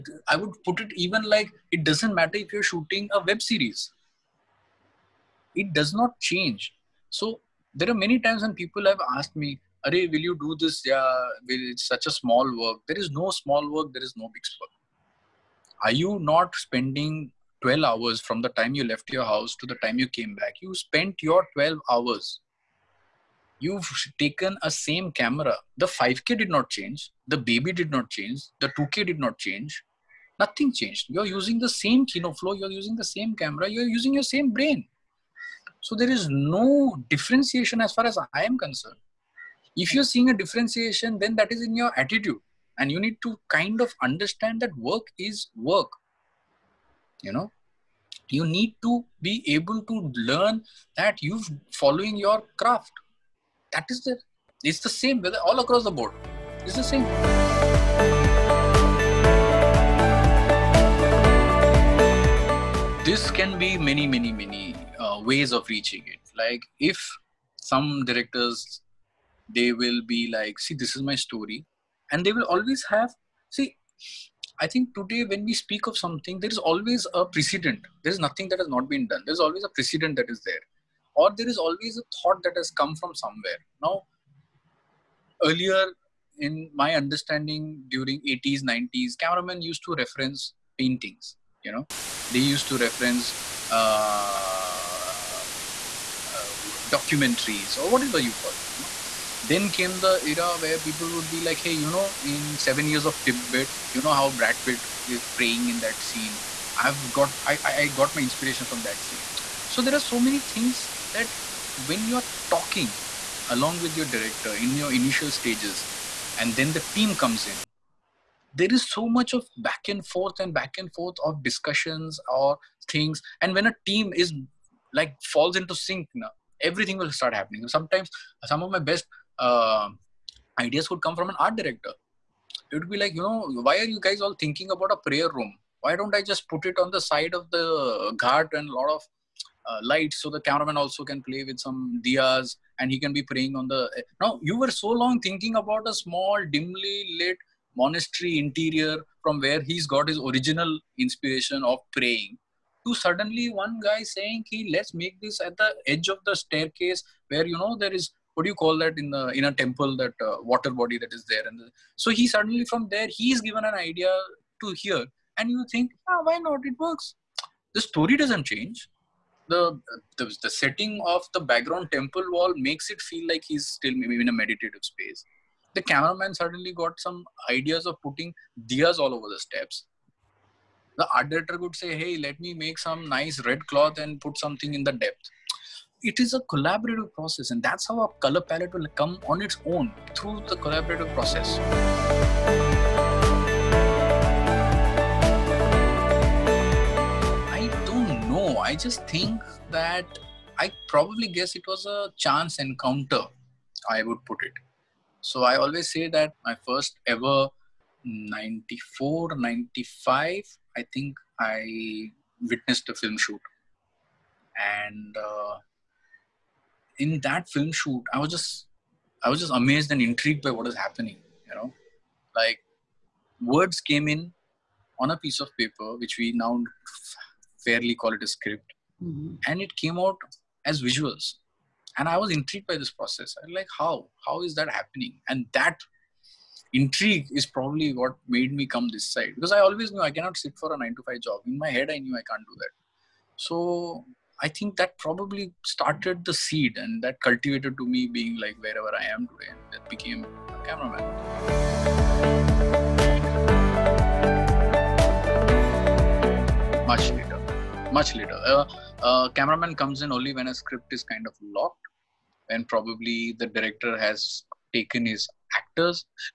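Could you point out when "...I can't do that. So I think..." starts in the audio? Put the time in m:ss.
4:02.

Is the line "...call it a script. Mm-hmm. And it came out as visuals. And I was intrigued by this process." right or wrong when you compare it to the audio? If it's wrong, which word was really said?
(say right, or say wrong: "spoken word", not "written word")
right.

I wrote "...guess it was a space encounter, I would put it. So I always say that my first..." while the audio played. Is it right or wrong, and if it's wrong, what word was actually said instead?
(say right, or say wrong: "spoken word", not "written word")
wrong: "chance", not "space".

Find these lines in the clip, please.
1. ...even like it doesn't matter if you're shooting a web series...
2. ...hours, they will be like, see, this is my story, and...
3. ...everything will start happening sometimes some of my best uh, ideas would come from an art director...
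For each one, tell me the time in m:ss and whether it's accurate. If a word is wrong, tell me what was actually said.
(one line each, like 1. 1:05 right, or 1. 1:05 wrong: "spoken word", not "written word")
1. 0:00 right
2. 1:08 wrong: "directors", not "hours"
3. 2:06 right.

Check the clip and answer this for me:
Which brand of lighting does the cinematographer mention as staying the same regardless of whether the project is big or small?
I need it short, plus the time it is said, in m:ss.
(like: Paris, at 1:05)
Kino Flo, at 0:32.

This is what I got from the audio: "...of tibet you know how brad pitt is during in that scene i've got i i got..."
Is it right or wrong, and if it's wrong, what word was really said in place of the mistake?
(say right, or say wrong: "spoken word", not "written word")
wrong: "praying", not "during".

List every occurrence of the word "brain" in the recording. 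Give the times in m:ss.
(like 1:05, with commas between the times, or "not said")
0:34.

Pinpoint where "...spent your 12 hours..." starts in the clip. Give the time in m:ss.
0:20.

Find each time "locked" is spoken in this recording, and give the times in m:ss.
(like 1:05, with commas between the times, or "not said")
4:21.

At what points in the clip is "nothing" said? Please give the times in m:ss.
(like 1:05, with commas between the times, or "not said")
0:30, 1:18.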